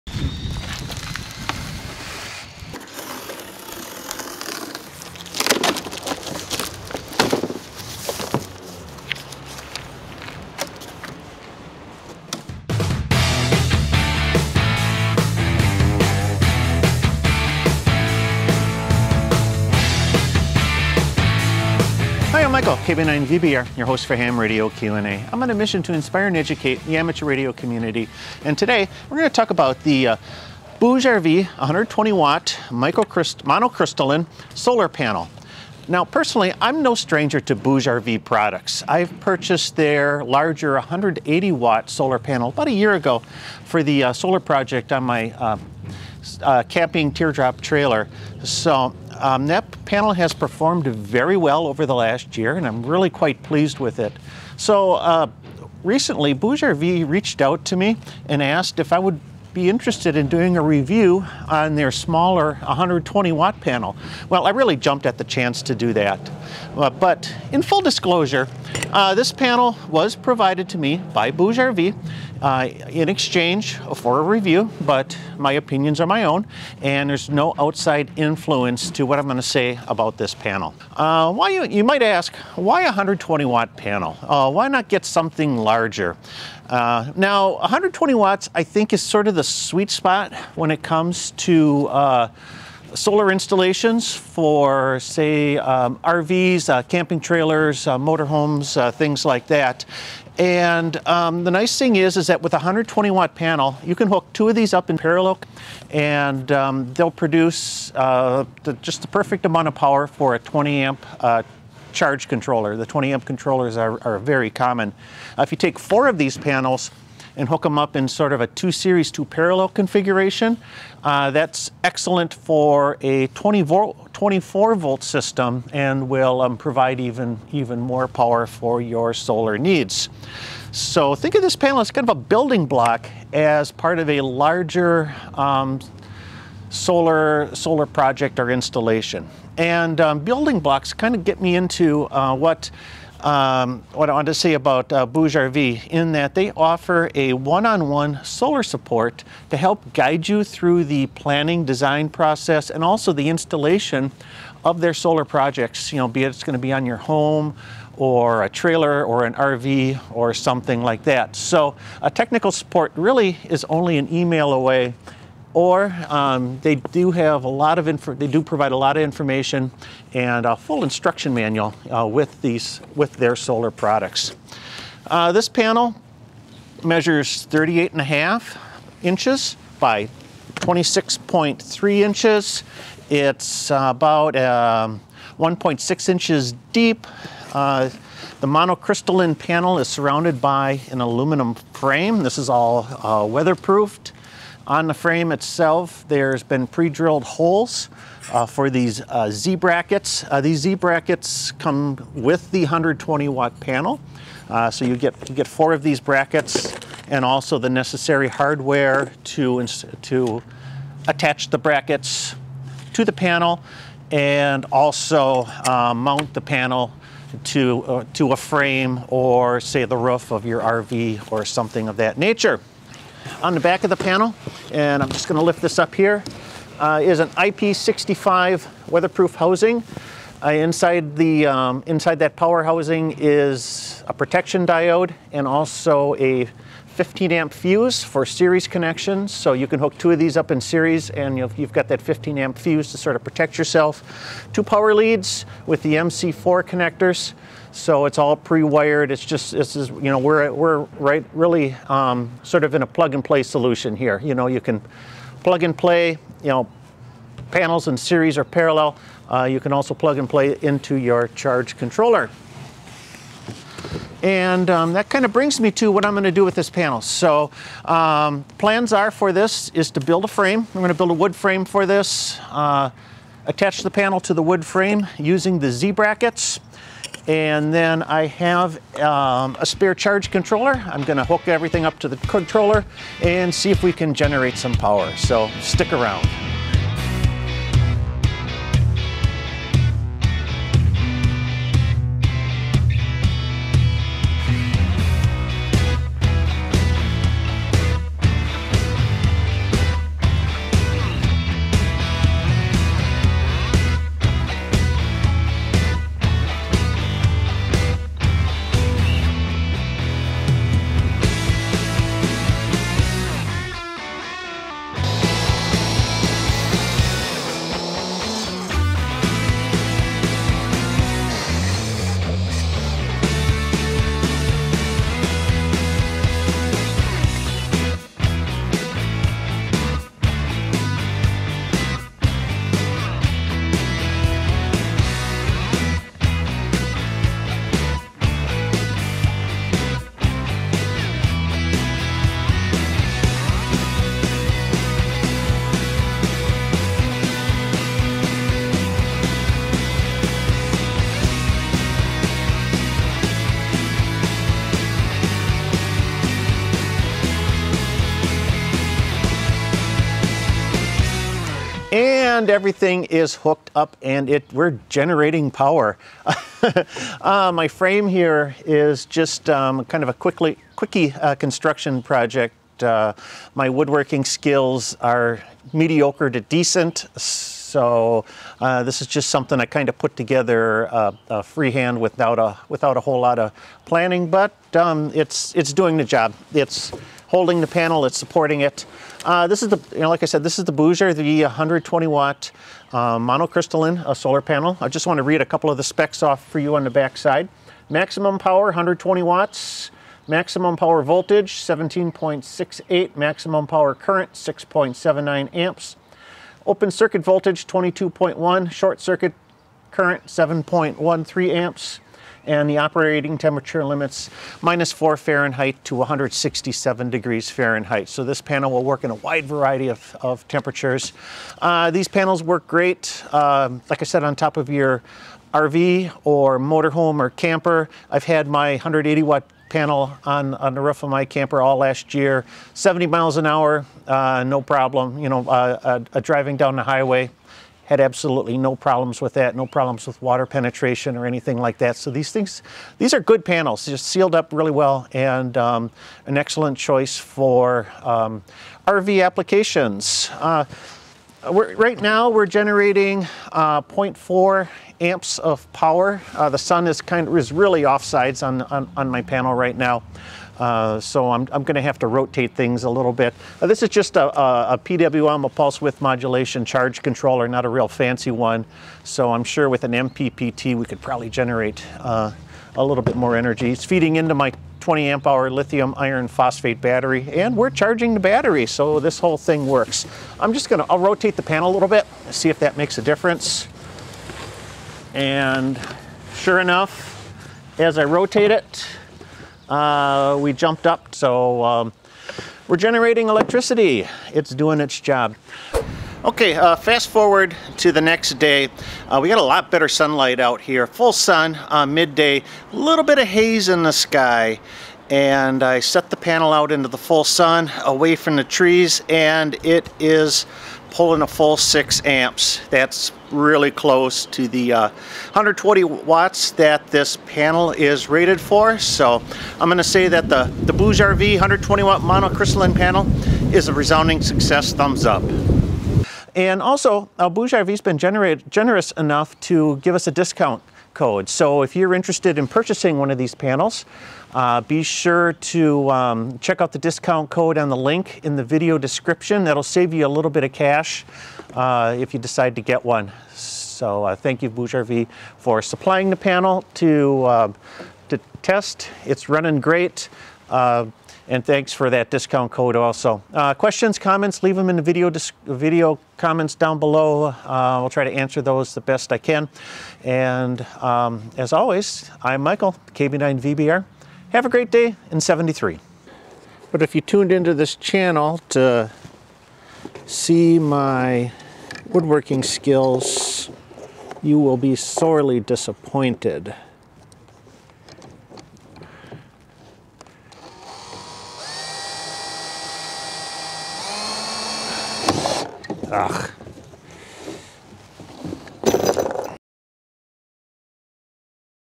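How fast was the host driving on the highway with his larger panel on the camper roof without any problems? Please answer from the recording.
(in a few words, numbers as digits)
70 miles an hour.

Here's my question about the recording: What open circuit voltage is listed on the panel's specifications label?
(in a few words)
22.1.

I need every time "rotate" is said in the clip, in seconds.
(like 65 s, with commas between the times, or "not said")
462 s, 480 s, 488 s.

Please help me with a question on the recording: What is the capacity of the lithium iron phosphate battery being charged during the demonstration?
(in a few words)
20 amp hour.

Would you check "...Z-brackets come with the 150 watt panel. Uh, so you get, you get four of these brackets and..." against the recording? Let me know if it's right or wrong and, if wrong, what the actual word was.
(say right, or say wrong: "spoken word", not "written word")
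wrong: "120", not "150".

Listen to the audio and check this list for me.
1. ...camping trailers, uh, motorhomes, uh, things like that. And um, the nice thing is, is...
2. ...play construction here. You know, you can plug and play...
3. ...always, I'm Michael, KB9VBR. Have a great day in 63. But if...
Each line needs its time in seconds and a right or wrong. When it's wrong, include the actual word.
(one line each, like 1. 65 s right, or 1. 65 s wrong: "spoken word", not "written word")
1. 96 s right
2. 253 s wrong: "solution", not "construction"
3. 561 s wrong: "73", not "63".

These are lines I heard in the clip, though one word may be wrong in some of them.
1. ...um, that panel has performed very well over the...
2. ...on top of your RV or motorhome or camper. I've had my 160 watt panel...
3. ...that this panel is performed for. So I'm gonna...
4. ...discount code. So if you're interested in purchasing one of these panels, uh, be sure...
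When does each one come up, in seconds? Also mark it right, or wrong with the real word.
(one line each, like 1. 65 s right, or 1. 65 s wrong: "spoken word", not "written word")
1. 49 s right
2. 424 s wrong: "180", not "160"
3. 516 s wrong: "rated", not "performed"
4. 530 s right.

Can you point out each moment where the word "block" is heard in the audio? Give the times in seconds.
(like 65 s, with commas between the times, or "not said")
132 s, 140 s.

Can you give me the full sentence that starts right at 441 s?
So these things, these are good panels, just sealed up really well and um, an excellent choice for um, RV applications.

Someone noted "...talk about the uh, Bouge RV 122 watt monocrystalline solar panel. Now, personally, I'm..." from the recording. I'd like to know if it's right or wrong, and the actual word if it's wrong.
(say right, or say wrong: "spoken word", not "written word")
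wrong: "120", not "122".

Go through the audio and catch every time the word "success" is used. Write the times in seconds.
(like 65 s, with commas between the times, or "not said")
524 s.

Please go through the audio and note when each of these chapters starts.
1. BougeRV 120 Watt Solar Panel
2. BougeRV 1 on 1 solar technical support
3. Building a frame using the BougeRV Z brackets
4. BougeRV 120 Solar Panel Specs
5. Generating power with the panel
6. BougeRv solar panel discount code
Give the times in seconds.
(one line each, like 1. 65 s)
1. 29 s
2. 140 s
3. 285 s
4. 363 s
5. 451 s
6. 527 s.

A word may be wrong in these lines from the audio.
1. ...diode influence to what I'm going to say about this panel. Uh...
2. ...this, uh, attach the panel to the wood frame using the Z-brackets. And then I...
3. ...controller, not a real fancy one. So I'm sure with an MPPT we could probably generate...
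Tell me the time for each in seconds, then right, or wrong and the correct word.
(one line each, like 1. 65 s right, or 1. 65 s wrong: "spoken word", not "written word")
1. 77 s wrong: "outside", not "diode"
2. 271 s right
3. 467 s right.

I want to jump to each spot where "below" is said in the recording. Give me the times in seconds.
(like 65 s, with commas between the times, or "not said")
556 s.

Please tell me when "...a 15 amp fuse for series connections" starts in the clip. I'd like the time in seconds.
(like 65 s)
236 s.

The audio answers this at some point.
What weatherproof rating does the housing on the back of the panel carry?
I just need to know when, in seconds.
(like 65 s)
227 s.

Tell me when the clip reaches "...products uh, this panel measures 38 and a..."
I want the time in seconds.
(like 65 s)
173 s.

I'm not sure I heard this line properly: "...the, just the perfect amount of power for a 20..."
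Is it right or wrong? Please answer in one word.
right.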